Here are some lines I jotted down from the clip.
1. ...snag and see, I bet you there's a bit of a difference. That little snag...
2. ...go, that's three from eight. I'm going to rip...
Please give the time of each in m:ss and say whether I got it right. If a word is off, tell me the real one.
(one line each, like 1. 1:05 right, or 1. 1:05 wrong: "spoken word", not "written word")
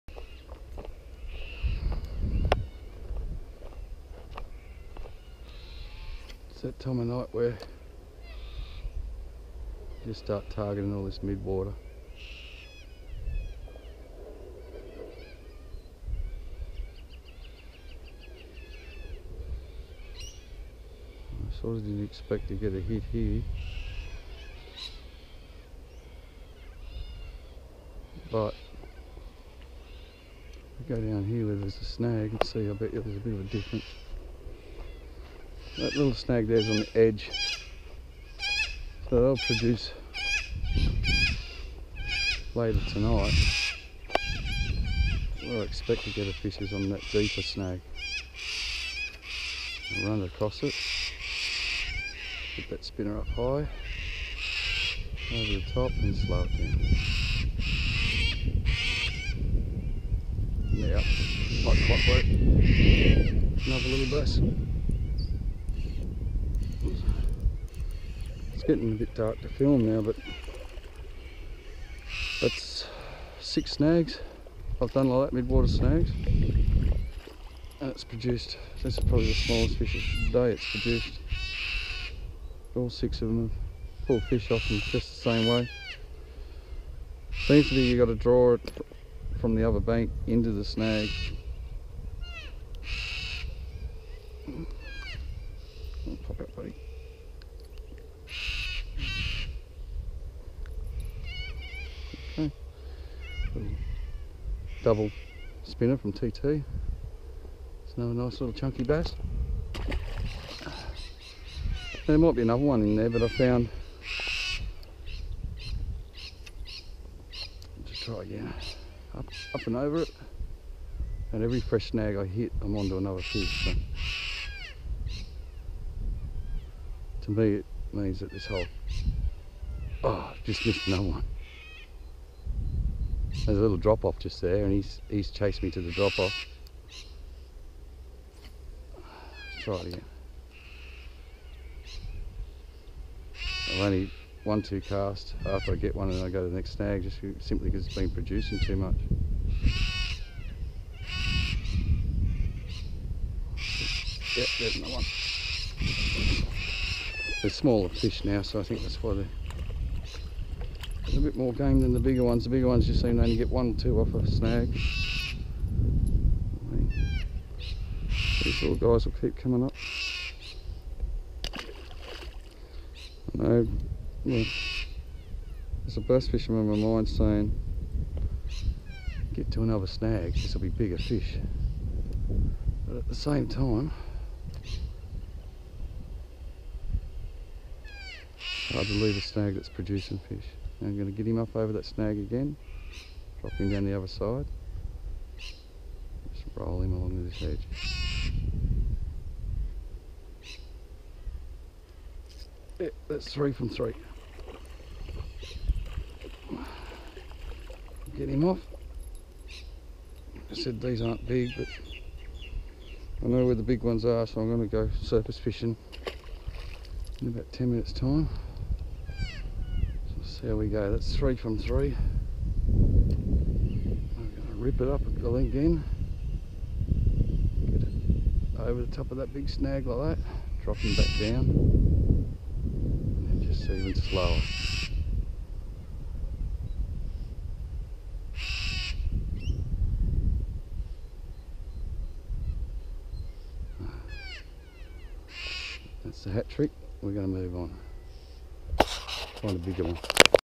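1. 0:31 right
2. 3:40 wrong: "three", not "eight".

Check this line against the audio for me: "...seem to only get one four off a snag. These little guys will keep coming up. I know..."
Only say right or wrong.
wrong.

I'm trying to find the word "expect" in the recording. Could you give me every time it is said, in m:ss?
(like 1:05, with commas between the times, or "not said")
0:22, 0:45.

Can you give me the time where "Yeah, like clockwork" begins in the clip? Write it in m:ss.
1:00.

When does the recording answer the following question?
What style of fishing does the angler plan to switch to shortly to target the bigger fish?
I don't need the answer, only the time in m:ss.
3:35.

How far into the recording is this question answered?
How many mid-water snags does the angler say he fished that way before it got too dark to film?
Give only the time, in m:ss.
1:13.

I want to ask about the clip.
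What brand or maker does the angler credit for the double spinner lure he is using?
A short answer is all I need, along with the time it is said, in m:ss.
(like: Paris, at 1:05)
TT, at 1:46.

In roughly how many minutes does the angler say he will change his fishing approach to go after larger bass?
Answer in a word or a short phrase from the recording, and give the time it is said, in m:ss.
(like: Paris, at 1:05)
10 minutes, at 3:37.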